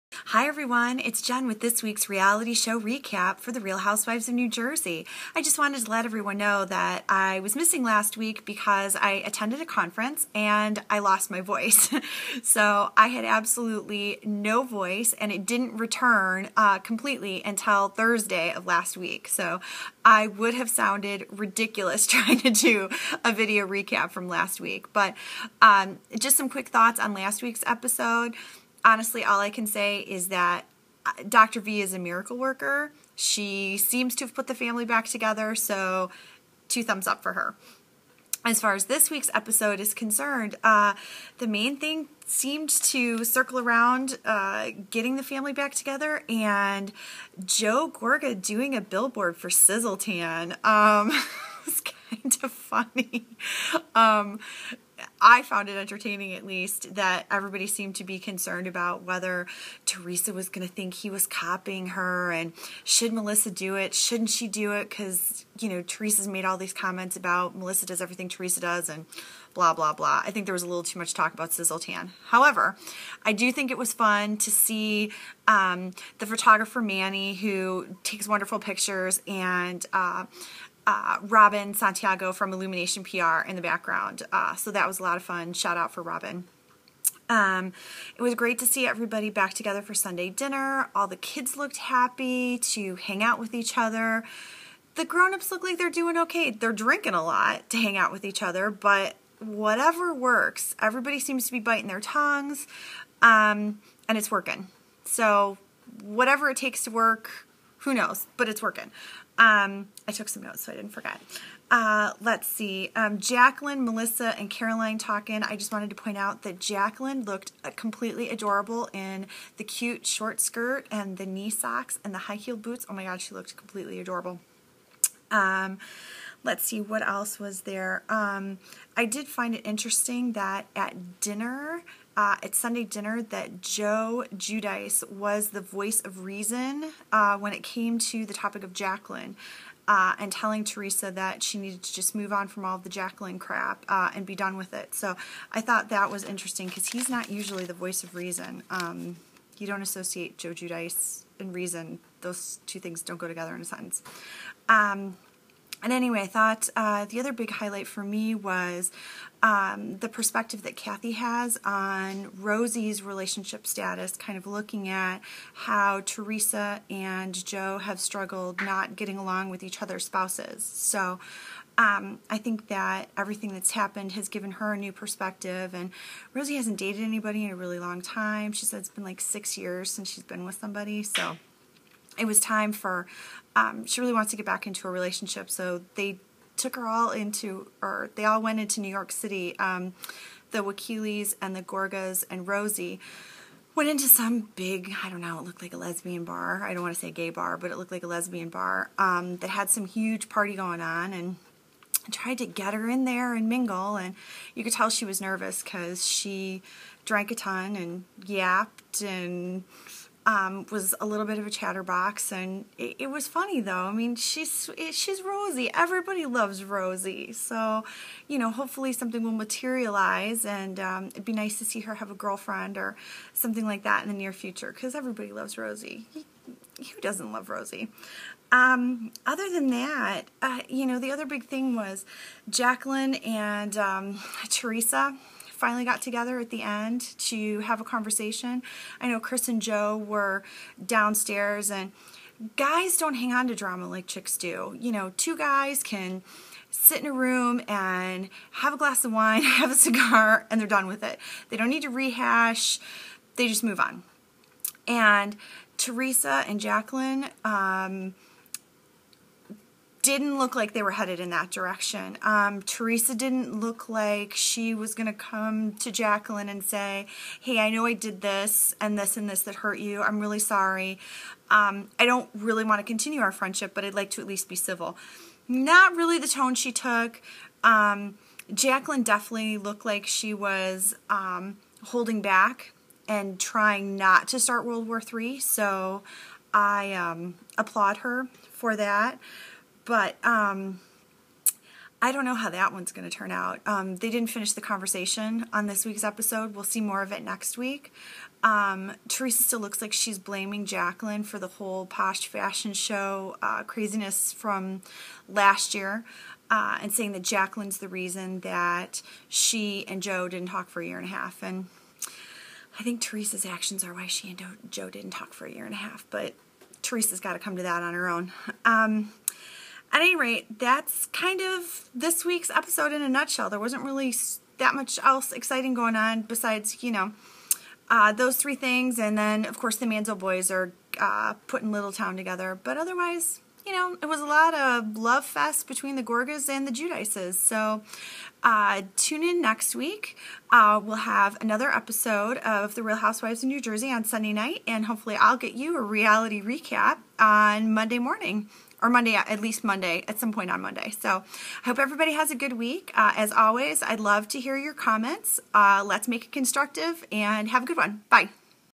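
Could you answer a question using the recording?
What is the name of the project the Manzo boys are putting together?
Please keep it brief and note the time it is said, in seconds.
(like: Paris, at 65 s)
Little Town, at 331 s.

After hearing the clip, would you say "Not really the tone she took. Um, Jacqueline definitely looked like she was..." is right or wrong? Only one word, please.
right.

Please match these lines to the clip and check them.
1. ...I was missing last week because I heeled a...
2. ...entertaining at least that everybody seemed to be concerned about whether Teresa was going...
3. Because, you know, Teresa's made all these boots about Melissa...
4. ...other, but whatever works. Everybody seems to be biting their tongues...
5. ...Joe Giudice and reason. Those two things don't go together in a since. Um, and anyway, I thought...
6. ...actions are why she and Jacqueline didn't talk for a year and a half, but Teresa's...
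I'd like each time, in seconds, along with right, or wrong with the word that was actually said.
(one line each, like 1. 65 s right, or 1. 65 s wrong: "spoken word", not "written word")
1. 7 s wrong: "attended", not "heeled"
2. 55 s right
3. 64 s wrong: "comments", not "boots"
4. 98 s right
5. 150 s wrong: "sentence", not "since"
6. 313 s wrong: "Joe", not "Jacqueline".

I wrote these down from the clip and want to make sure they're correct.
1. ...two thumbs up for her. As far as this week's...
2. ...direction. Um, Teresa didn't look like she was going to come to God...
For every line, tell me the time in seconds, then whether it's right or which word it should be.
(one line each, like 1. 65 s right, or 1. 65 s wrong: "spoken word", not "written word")
1. 36 s right
2. 261 s wrong: "Jacqueline", not "God".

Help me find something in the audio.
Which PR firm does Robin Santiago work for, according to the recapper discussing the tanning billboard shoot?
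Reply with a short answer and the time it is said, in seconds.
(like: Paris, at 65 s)
Illumination PR, at 82 s.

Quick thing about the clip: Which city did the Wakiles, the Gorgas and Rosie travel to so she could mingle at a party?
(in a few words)
New York City.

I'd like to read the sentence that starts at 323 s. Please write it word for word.
There wasn't really that much else exciting going on besides, you know, uh, those three things.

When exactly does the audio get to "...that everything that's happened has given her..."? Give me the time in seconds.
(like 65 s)
172 s.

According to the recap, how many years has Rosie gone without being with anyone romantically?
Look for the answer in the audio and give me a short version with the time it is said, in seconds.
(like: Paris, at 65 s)
6, at 179 s.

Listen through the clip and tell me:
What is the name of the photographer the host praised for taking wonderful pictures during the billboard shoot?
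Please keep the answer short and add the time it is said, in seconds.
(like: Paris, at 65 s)
Manny, at 76 s.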